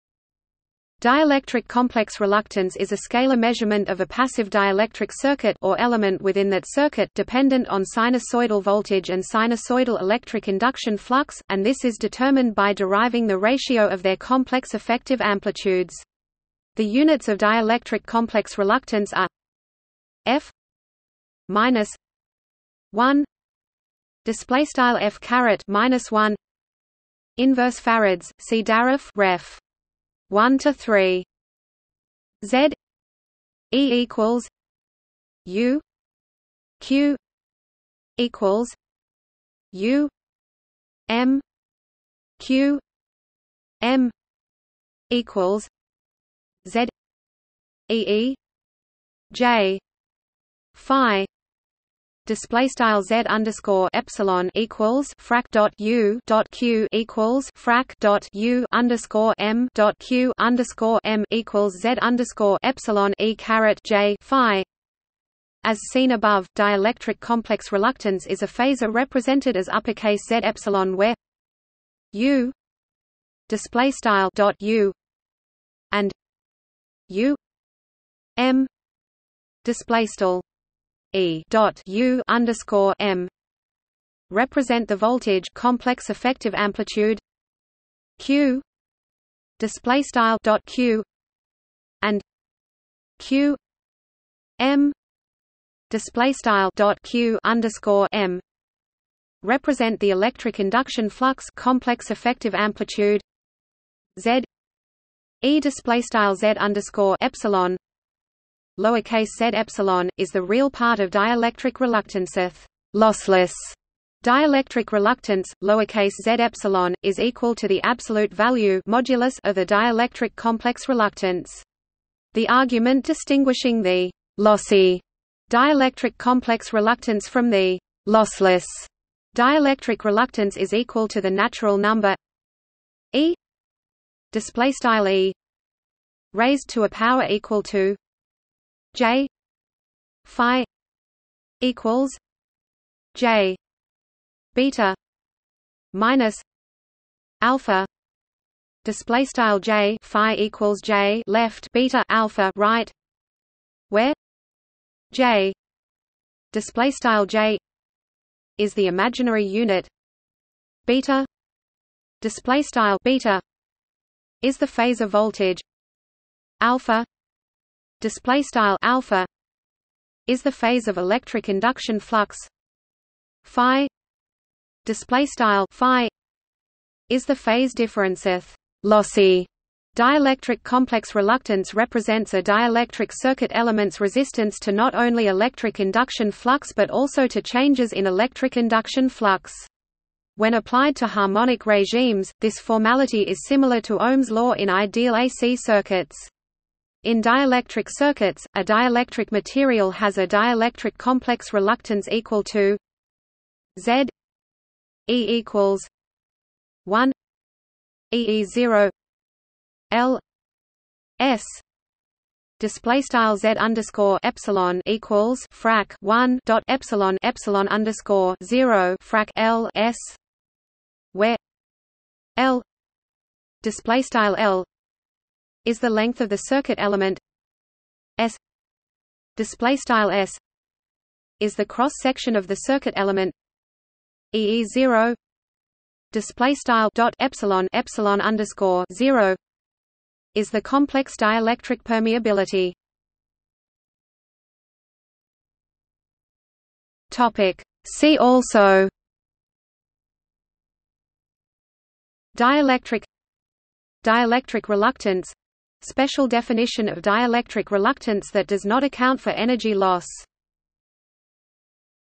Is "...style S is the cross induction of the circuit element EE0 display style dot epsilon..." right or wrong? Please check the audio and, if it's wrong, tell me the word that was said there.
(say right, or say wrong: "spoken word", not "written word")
wrong: "section", not "induction".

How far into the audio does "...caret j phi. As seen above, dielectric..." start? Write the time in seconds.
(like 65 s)
63 s.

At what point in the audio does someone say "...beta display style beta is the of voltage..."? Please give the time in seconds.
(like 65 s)
160 s.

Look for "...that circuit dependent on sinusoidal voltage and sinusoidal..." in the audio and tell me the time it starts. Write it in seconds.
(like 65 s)
6 s.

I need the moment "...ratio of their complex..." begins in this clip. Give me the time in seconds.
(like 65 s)
13 s.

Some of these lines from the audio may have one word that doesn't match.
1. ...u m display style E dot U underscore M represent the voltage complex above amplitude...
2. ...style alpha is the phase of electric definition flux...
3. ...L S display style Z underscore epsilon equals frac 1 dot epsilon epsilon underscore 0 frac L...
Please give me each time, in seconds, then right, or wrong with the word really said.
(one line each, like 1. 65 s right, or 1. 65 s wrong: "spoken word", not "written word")
1. 77 s wrong: "effective", not "above"
2. 168 s wrong: "induction", not "definition"
3. 209 s right.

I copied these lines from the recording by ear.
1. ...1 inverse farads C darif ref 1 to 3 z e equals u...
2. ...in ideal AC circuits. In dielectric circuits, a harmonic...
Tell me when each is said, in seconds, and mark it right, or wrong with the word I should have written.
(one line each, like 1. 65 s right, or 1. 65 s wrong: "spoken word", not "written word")
1. 26 s right
2. 194 s wrong: "dielectric", not "harmonic".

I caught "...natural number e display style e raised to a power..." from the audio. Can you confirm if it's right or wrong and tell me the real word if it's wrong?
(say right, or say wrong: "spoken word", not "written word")
right.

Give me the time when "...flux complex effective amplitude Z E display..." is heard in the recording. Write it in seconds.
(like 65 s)
101 s.